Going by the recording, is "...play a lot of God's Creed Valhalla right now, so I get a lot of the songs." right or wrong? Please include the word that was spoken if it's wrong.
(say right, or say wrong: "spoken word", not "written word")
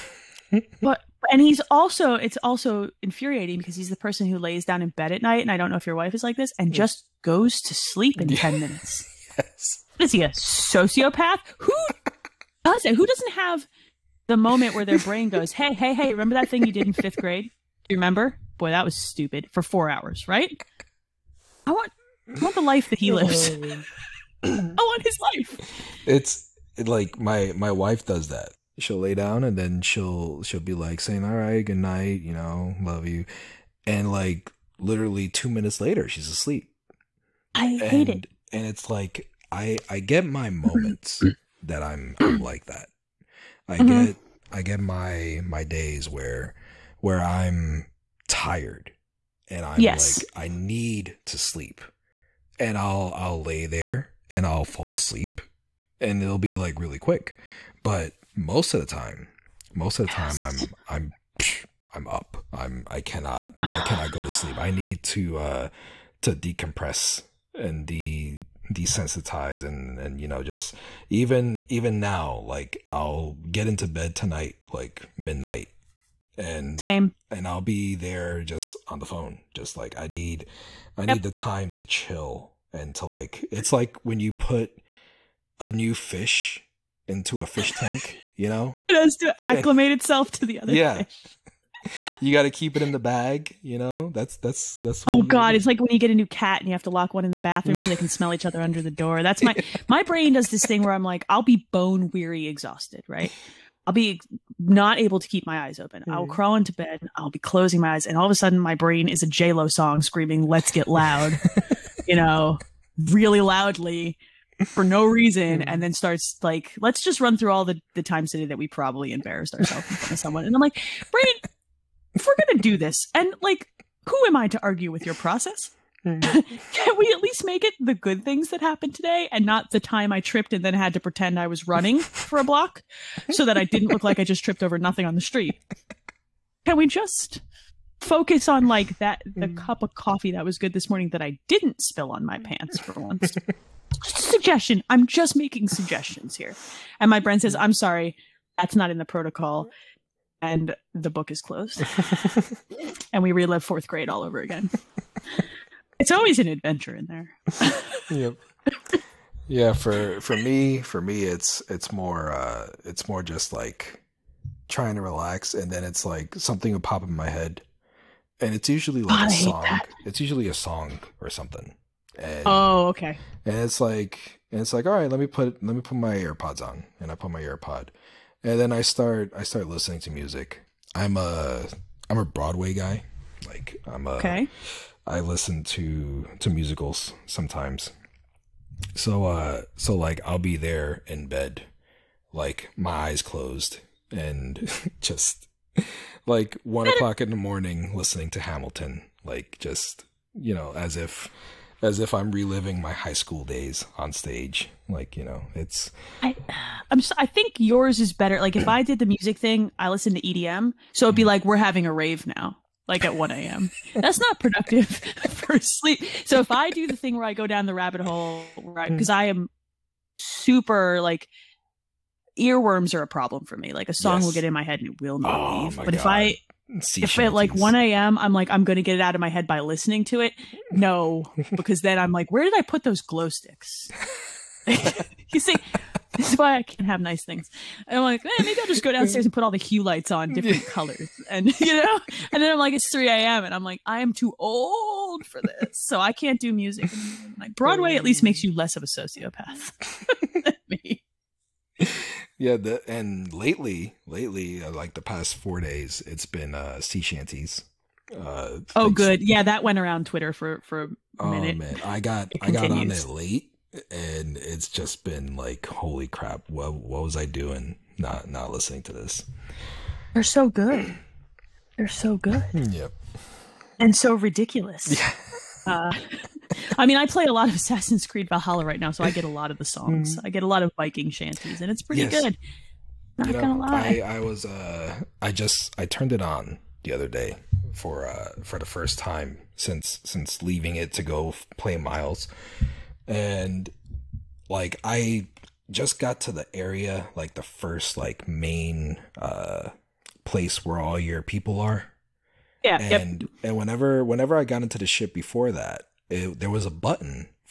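wrong: "Assassin", not "God".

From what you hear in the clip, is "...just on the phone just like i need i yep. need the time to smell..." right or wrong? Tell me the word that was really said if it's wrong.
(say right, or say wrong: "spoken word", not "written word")
wrong: "chill", not "smell".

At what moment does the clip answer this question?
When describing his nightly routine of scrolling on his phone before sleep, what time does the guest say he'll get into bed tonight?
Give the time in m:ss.
1:15.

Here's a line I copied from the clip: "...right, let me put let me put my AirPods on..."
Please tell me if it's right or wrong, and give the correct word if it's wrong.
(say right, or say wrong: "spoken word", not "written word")
right.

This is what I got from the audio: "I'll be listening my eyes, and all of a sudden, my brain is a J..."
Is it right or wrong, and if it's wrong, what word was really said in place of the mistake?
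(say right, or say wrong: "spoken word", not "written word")
wrong: "closing", not "listening".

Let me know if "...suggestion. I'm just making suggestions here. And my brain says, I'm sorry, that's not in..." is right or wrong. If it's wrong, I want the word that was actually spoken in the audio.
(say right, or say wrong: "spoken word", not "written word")
right.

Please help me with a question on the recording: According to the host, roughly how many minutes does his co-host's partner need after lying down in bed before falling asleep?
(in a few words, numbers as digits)
10.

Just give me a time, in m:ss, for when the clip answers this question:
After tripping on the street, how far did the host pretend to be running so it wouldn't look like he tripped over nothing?
2:12.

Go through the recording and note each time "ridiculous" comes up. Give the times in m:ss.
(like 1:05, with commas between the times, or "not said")
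4:34.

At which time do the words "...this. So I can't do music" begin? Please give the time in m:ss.
4:05.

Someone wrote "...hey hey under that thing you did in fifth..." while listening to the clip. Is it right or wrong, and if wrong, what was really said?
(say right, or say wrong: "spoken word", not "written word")
wrong: "remember", not "under".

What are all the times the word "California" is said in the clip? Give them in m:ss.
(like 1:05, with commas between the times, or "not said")
not said.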